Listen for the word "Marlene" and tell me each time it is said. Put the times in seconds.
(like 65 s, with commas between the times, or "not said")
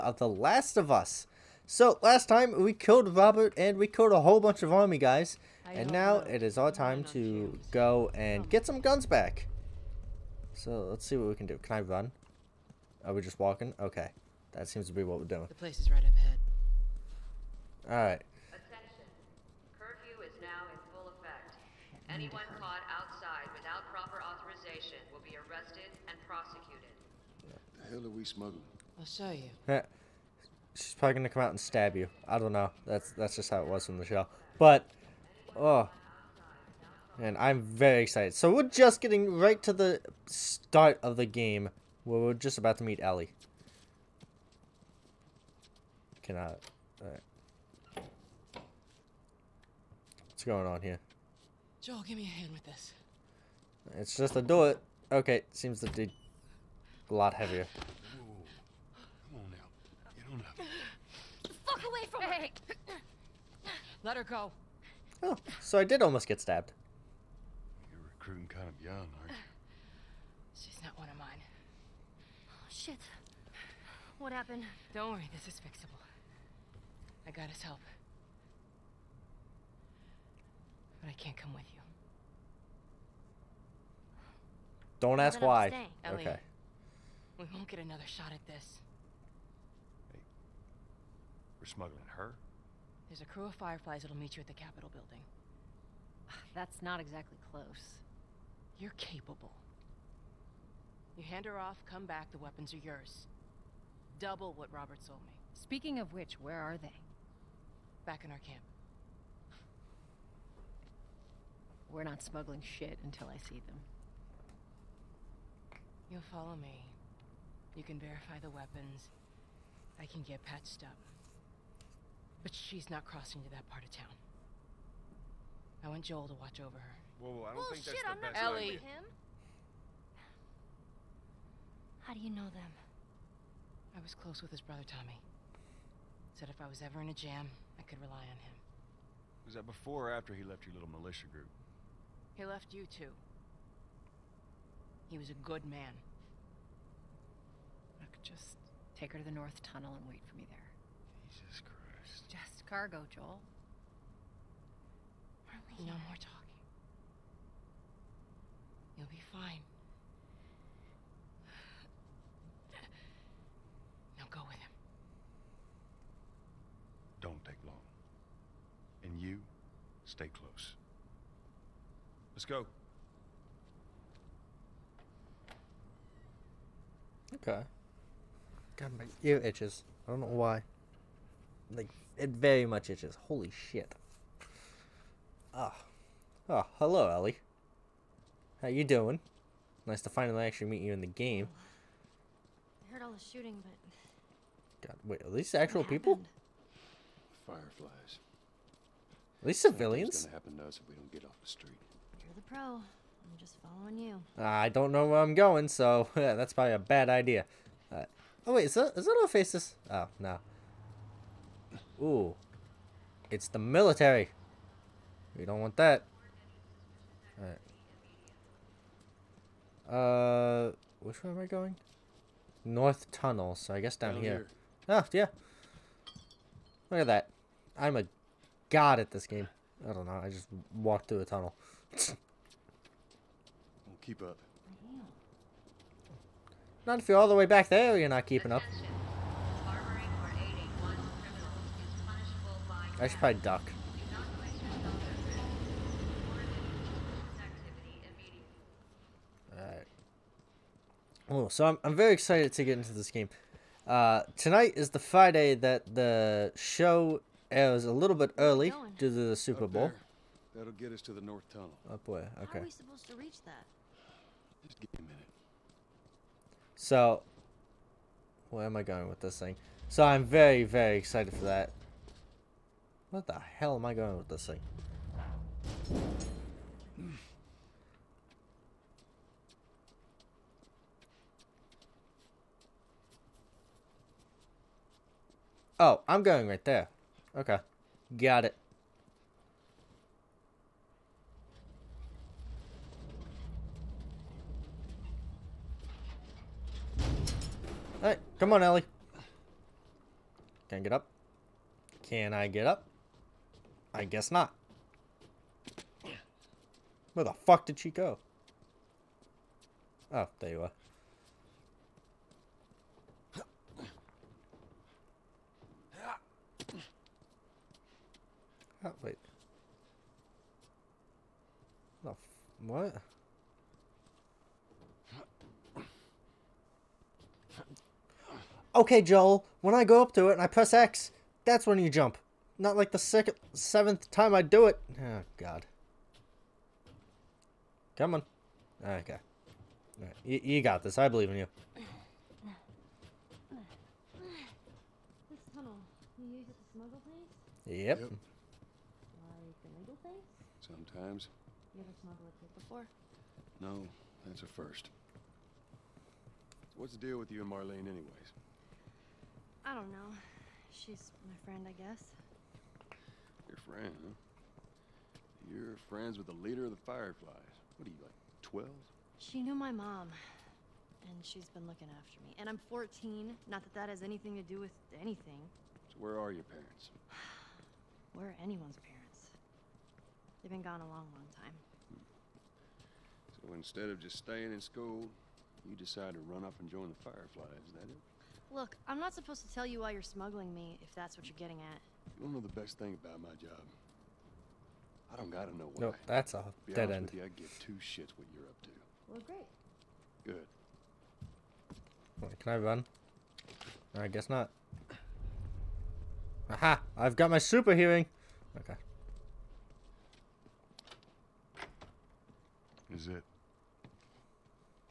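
155 s, 357 s.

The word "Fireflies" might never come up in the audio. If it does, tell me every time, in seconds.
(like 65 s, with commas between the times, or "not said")
93 s, 197 s, 366 s, 387 s.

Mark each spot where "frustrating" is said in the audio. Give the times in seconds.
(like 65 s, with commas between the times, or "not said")
not said.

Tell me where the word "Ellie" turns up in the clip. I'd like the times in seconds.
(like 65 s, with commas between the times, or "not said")
43 s, 128 s, 187 s, 298 s.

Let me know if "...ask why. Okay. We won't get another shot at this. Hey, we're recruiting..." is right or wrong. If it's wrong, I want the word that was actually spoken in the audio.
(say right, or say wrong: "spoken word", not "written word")
wrong: "smuggling", not "recruiting".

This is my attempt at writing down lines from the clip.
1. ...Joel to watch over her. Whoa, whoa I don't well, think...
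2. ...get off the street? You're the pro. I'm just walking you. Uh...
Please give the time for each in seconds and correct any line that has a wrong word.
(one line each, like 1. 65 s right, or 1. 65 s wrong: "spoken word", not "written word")
1. 126 s right
2. 201 s wrong: "following", not "walking".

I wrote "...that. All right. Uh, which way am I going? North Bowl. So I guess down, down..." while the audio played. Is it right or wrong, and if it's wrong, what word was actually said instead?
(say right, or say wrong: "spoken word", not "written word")
wrong: "Tunnel", not "Bowl".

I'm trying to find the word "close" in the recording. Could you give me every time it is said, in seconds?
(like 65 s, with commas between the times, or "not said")
97 s, 134 s, 170 s.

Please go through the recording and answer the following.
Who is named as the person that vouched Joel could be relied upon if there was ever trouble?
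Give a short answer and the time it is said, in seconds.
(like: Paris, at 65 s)
Tommy, at 134 s.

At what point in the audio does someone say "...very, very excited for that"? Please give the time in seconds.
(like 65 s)
270 s.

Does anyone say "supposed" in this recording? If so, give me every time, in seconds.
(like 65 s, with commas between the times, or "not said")
262 s, 389 s.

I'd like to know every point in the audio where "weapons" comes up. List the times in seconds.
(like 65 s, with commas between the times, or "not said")
102 s, 118 s.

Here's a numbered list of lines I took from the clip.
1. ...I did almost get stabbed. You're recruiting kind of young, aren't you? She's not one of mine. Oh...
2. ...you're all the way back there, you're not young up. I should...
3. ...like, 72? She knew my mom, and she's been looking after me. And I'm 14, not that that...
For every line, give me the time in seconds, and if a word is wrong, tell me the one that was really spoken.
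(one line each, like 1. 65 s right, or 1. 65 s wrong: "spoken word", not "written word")
1. 65 s right
2. 237 s wrong: "keeping", not "young"
3. 368 s wrong: "12", not "72".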